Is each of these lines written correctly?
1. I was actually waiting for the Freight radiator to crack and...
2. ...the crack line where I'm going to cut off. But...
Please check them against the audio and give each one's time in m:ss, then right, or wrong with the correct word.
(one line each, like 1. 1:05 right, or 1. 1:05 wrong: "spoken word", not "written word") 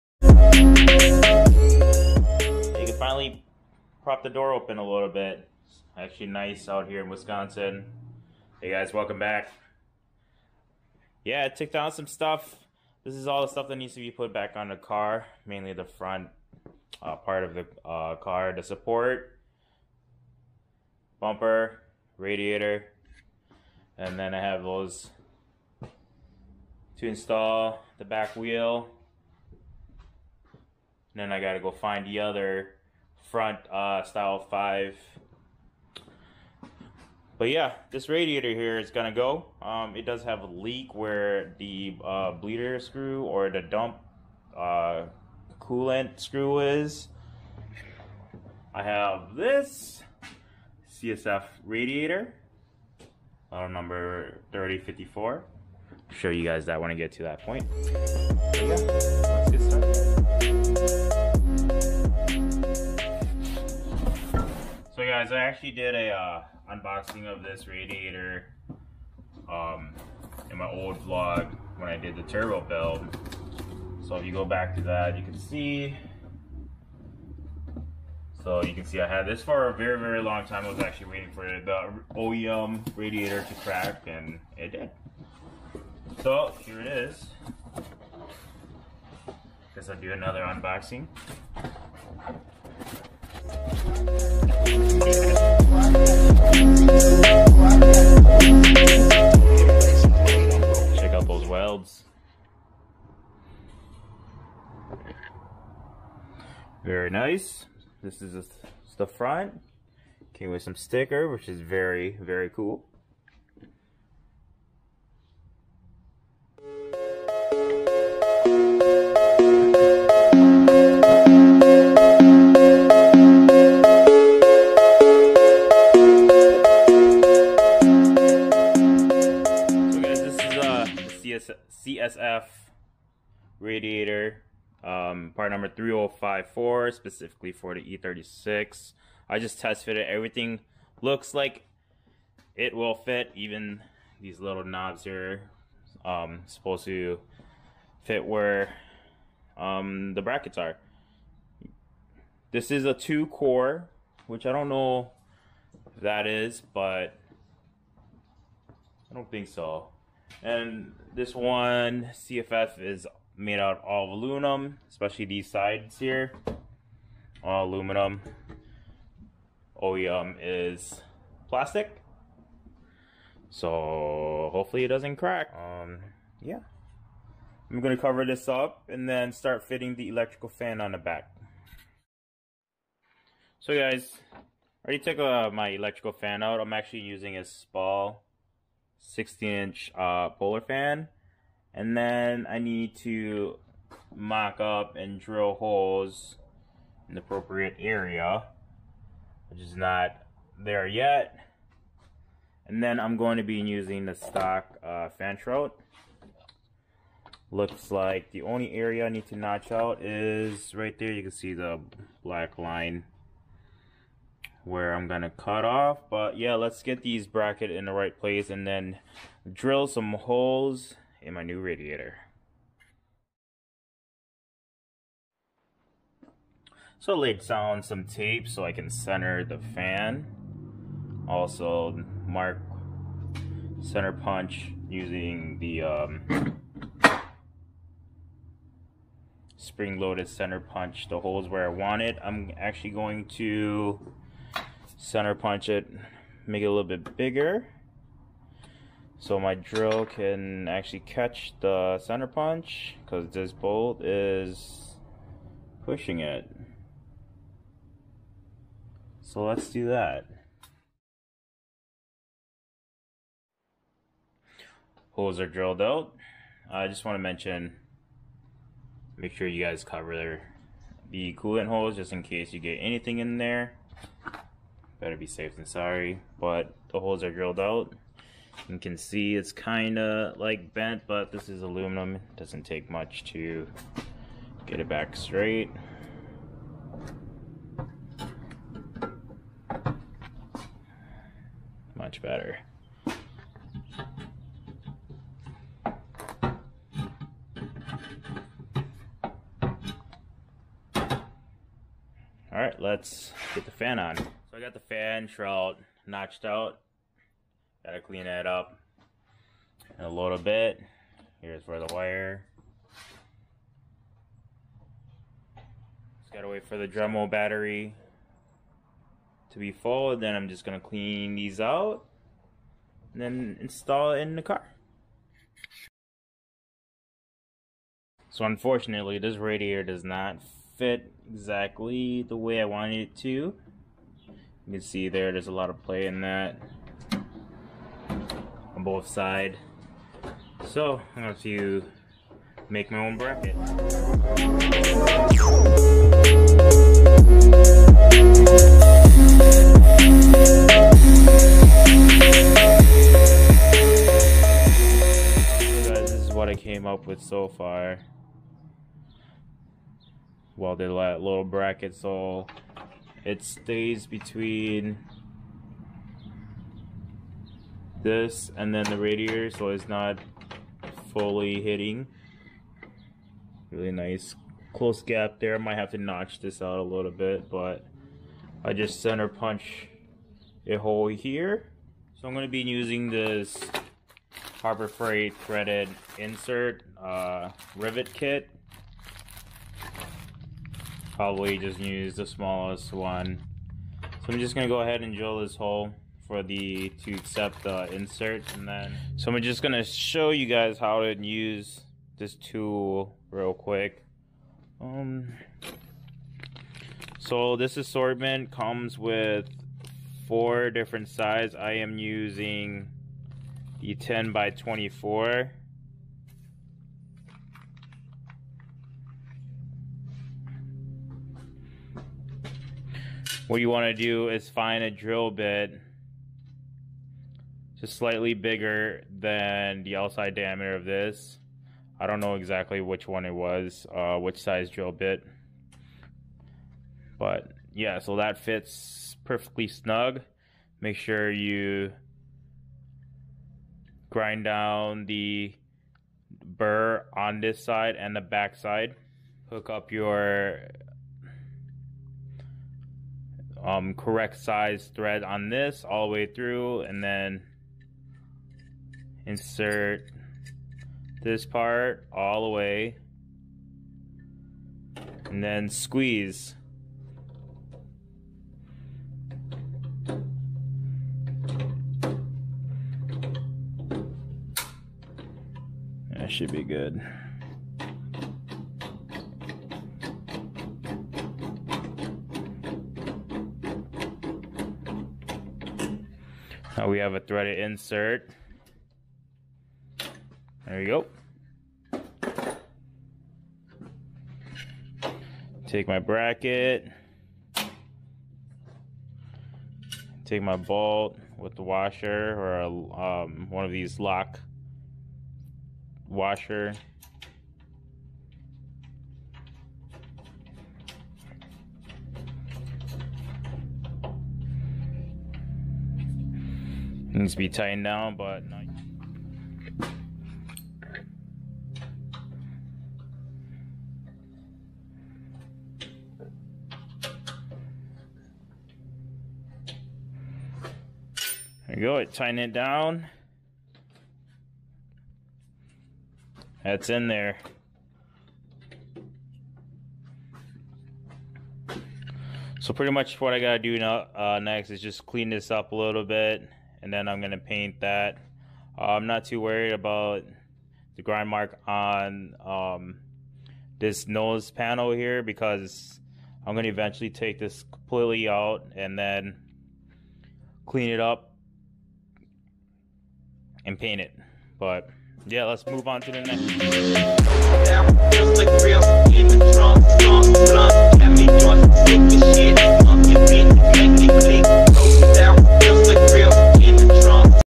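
1. 1:20 wrong: "OEM", not "Freight"
2. 3:31 wrong: "black", not "crack".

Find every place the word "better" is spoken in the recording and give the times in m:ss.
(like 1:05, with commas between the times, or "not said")
4:35, 4:52.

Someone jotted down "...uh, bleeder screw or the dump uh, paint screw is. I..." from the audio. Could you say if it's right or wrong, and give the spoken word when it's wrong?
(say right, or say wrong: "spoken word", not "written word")
wrong: "coolant", not "paint".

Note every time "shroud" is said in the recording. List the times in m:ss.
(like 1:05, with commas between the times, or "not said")
3:25, 5:05.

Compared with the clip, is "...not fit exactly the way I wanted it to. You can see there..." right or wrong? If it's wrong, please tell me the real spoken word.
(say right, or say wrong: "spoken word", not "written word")
right.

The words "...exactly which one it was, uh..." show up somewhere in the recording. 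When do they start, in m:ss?
7:12.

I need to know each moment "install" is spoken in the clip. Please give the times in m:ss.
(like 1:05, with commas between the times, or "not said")
0:27, 5:23.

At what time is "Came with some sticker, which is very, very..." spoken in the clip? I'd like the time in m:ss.
1:50.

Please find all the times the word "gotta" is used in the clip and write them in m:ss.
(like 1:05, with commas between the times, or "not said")
0:31, 5:07, 5:16, 9:03.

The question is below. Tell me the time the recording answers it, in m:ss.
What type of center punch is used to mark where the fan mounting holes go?
3:59.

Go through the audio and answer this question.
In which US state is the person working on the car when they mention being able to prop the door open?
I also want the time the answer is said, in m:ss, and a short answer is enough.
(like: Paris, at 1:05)
Wisconsin, at 0:07.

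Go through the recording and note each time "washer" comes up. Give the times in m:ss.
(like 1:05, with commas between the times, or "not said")
8:21, 8:26.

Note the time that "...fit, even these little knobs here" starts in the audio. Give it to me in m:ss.
2:22.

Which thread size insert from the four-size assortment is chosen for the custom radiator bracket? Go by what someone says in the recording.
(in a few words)
10 by 24.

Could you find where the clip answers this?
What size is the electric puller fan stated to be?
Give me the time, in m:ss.
3:09.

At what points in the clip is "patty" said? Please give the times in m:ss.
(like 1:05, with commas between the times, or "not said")
not said.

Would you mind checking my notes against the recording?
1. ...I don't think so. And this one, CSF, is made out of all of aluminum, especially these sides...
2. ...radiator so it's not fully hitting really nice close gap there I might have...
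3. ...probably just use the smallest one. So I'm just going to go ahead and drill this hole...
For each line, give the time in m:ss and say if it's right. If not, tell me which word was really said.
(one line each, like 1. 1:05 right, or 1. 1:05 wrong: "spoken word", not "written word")
1. 2:39 right
2. 6:08 right
3. 6:31 right.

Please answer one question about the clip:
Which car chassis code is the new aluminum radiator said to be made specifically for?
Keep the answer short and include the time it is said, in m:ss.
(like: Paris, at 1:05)
E36, at 2:17.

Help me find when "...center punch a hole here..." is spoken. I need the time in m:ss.
6:19.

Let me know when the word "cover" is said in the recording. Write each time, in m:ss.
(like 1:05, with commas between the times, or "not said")
2:58, 4:29.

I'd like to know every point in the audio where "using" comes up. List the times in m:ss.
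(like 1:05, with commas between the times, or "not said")
3:07, 3:23, 3:54, 6:22, 6:51.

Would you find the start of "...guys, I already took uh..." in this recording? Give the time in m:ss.
3:03.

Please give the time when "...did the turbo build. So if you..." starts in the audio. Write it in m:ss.
1:11.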